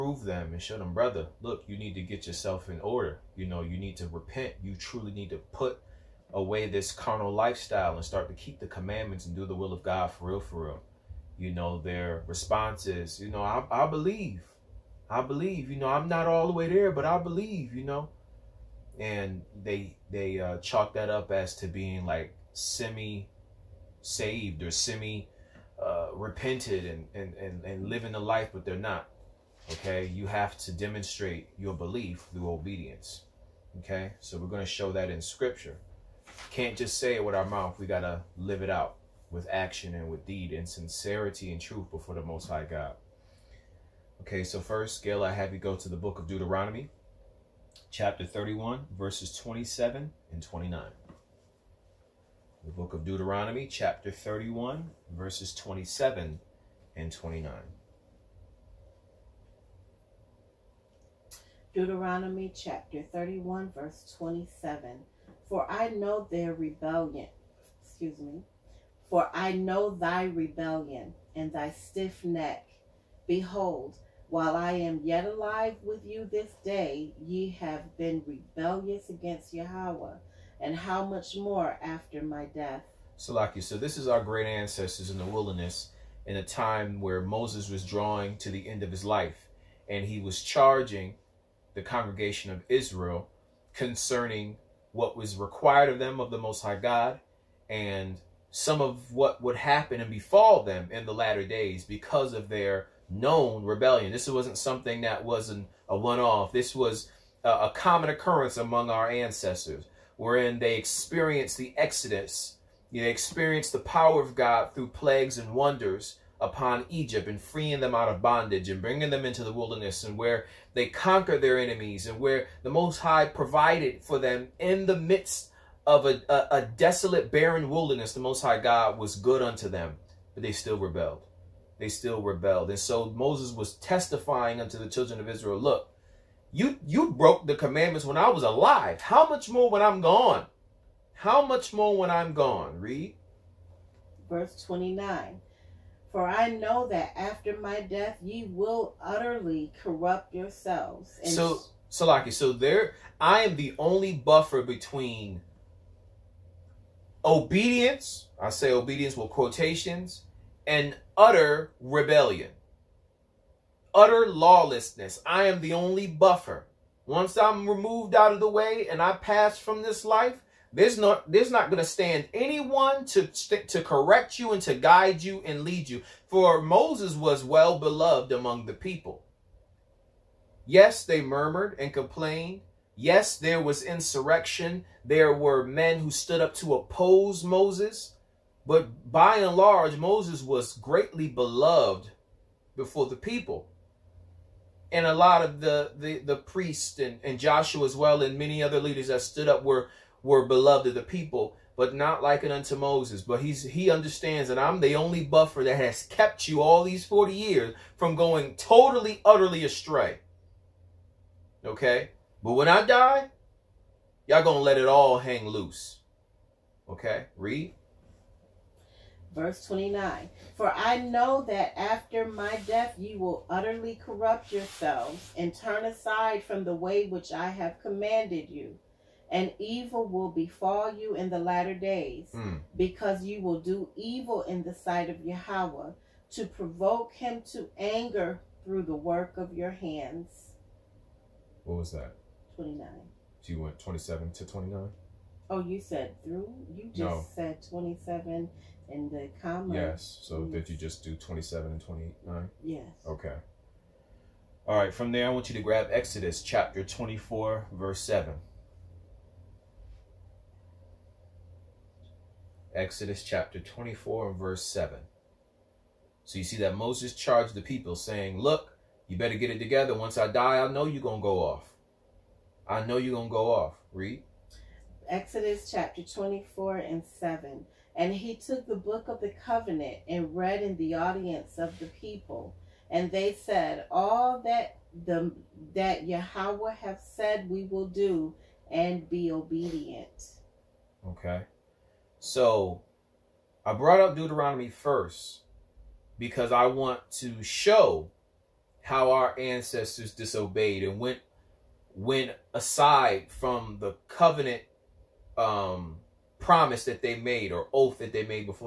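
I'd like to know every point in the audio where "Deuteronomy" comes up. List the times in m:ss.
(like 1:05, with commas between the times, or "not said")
0:46, 0:53, 1:01, 4:54.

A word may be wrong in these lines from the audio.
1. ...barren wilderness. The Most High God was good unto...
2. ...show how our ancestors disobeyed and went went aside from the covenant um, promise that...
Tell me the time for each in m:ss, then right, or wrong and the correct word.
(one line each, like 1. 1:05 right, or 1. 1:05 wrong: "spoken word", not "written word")
1. 2:07 right
2. 4:57 right.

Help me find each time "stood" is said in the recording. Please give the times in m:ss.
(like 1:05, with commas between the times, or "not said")
3:06, 3:19.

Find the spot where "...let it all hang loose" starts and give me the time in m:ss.
3:34.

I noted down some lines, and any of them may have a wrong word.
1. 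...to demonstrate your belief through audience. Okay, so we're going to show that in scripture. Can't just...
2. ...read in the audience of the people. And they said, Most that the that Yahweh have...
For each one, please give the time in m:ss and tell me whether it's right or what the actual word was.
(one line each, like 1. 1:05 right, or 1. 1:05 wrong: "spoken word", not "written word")
1. 0:30 wrong: "obedience", not "audience"
2. 4:40 wrong: "All", not "Most".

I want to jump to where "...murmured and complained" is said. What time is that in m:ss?
3:01.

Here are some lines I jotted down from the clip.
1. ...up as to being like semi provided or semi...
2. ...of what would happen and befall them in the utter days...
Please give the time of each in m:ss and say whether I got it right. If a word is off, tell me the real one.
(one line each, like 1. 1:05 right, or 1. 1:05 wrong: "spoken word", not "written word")
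1. 0:21 wrong: "saved", not "provided"
2. 1:38 wrong: "latter", not "utter".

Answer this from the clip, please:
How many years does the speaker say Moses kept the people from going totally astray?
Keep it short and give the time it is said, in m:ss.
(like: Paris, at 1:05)
40, at 3:27.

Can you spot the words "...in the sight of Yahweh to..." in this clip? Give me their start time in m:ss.
3:54.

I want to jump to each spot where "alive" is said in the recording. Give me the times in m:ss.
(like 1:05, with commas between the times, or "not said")
1:15, 2:18.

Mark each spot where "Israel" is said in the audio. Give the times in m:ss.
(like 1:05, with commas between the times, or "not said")
1:32, 2:15.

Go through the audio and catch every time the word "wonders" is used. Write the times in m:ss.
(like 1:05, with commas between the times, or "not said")
1:55.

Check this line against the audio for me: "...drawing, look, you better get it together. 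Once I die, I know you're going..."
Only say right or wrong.
wrong.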